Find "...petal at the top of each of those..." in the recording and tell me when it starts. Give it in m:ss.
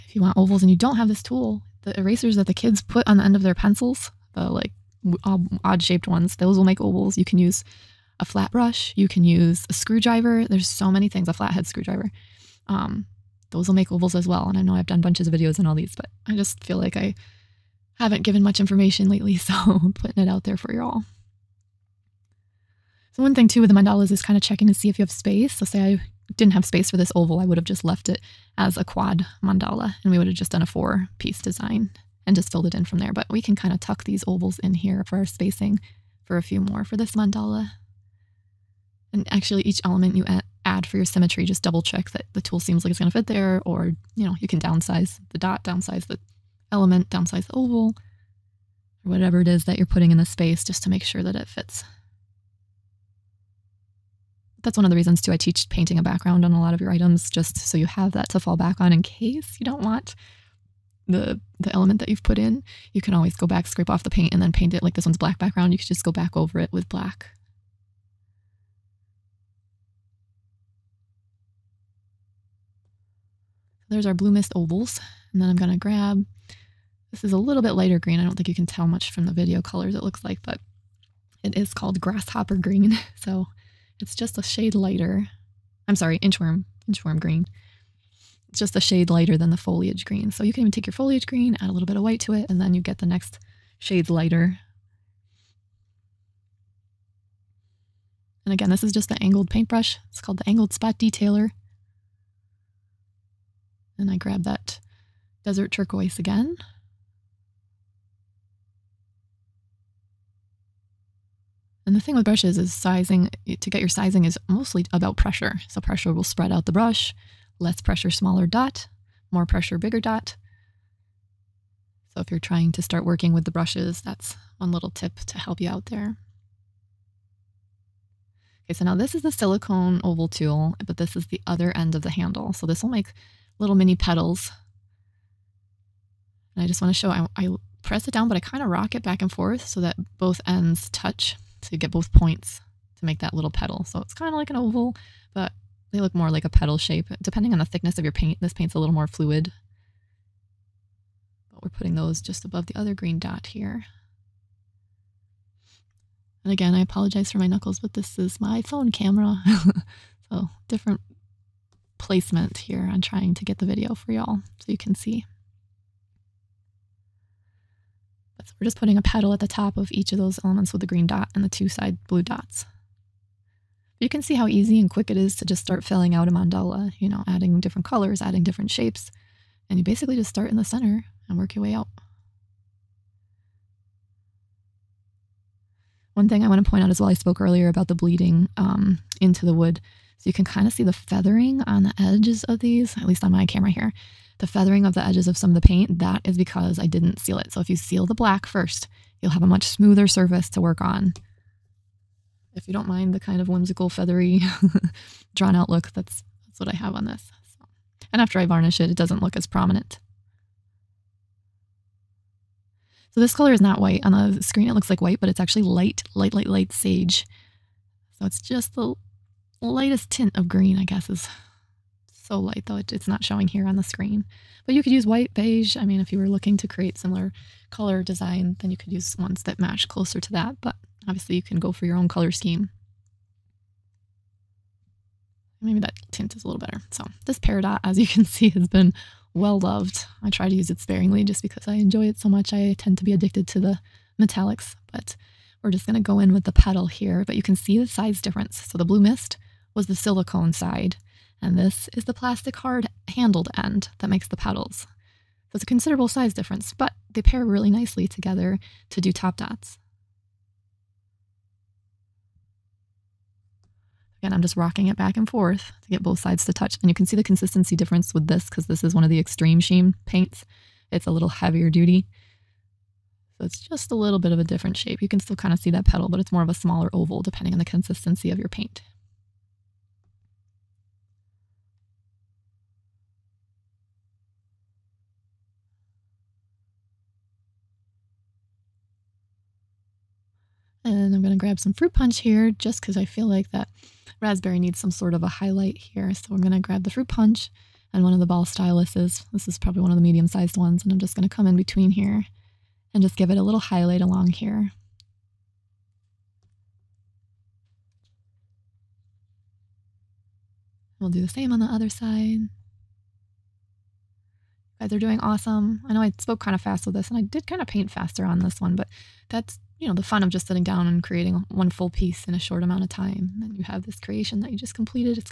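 2:49.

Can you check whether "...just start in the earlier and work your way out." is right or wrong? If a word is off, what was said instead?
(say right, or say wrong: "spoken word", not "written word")
wrong: "center", not "earlier".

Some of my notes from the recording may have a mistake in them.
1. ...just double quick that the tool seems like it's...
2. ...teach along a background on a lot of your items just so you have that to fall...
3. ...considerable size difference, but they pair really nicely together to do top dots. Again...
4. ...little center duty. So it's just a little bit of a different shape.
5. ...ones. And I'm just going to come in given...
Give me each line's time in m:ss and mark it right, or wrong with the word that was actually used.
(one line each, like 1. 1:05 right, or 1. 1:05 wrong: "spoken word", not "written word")
1. 0:41 wrong: "check", not "quick"
2. 0:55 wrong: "painting", not "along"
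3. 4:15 right
4. 4:31 wrong: "heavier", not "center"
5. 5:00 wrong: "between", not "given".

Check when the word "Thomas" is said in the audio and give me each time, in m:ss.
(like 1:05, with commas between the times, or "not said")
not said.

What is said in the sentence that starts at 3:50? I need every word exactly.
But obviously, you can go for your own color scheme.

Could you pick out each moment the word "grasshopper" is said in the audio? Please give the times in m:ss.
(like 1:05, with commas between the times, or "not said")
1:22.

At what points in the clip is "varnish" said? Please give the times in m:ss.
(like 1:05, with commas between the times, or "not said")
3:28.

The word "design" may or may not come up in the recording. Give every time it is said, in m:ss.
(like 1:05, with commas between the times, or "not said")
0:31, 3:48.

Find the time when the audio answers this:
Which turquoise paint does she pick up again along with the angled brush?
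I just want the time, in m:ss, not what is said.
1:45.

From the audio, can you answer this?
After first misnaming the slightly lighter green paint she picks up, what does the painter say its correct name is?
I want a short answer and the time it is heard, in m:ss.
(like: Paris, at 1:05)
Inchworm green, at 1:26.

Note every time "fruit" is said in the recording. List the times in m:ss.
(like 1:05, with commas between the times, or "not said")
4:51, 4:56.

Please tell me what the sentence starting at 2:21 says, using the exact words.
So you get both points to make that little petal.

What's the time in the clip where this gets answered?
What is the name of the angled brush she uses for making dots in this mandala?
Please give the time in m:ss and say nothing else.
1:40.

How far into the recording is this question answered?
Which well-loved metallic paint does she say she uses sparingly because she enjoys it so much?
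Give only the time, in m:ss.
3:57.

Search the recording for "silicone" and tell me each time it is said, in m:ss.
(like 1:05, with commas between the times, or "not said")
2:09, 4:09.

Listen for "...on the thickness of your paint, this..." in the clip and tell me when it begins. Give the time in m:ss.
2:27.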